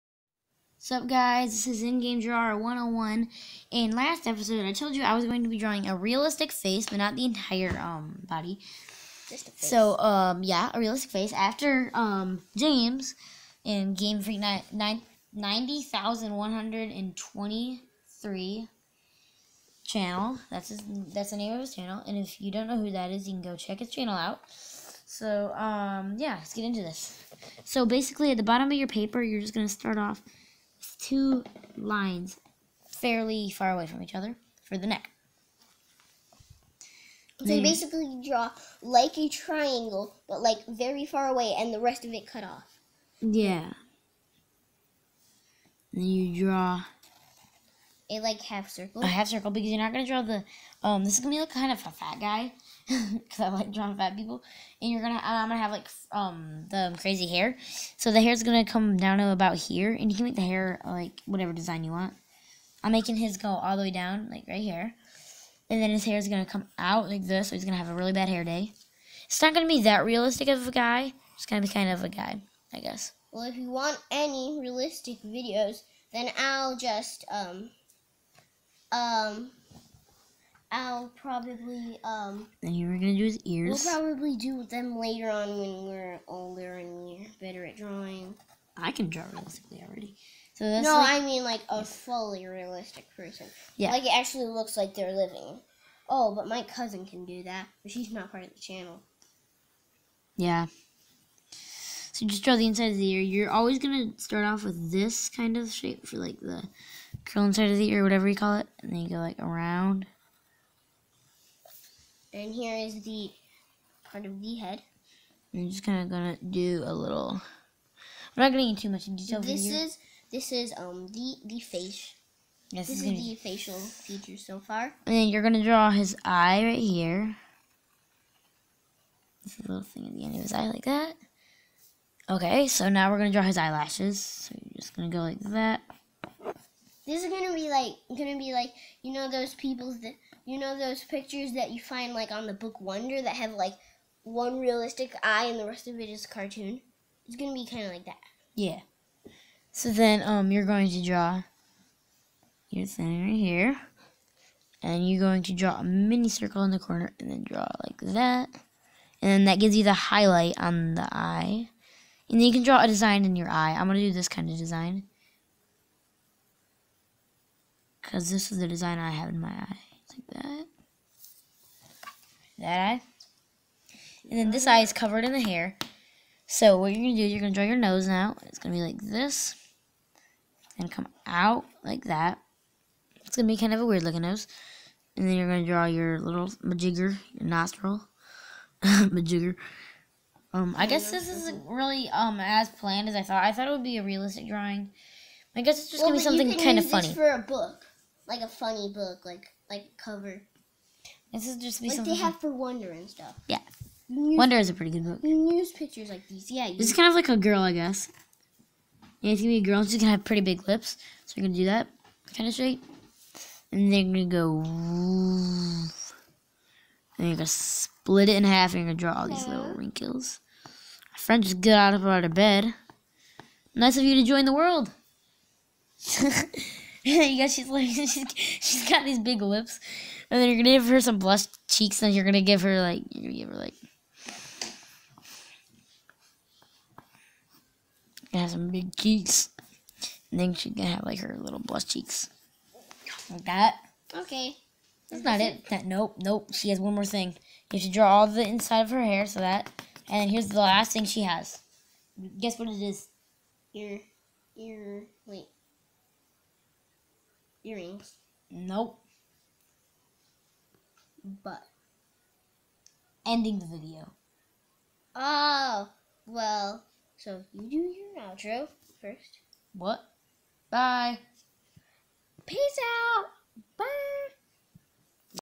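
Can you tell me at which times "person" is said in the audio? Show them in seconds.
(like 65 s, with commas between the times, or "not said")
93 s.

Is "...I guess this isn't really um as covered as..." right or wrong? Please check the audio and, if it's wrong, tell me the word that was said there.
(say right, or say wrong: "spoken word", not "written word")
wrong: "planned", not "covered".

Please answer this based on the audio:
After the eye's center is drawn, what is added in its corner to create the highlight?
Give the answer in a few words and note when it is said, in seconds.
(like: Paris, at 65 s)
a mini circle, at 155 s.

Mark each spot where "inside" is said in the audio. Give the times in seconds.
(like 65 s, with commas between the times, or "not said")
102 s, 107 s, 248 s.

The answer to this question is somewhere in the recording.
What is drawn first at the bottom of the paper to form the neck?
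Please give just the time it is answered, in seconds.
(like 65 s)
31 s.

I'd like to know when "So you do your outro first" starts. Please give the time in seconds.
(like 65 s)
267 s.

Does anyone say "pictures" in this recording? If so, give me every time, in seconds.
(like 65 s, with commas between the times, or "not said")
141 s, 205 s.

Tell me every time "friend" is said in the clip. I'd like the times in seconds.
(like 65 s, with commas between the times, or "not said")
221 s.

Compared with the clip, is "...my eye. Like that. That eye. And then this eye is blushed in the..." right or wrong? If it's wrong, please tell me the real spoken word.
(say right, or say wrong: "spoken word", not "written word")
wrong: "covered", not "blushed".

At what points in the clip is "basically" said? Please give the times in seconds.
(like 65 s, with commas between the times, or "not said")
27 s, 37 s.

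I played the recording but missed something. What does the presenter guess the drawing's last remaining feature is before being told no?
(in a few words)
earrings.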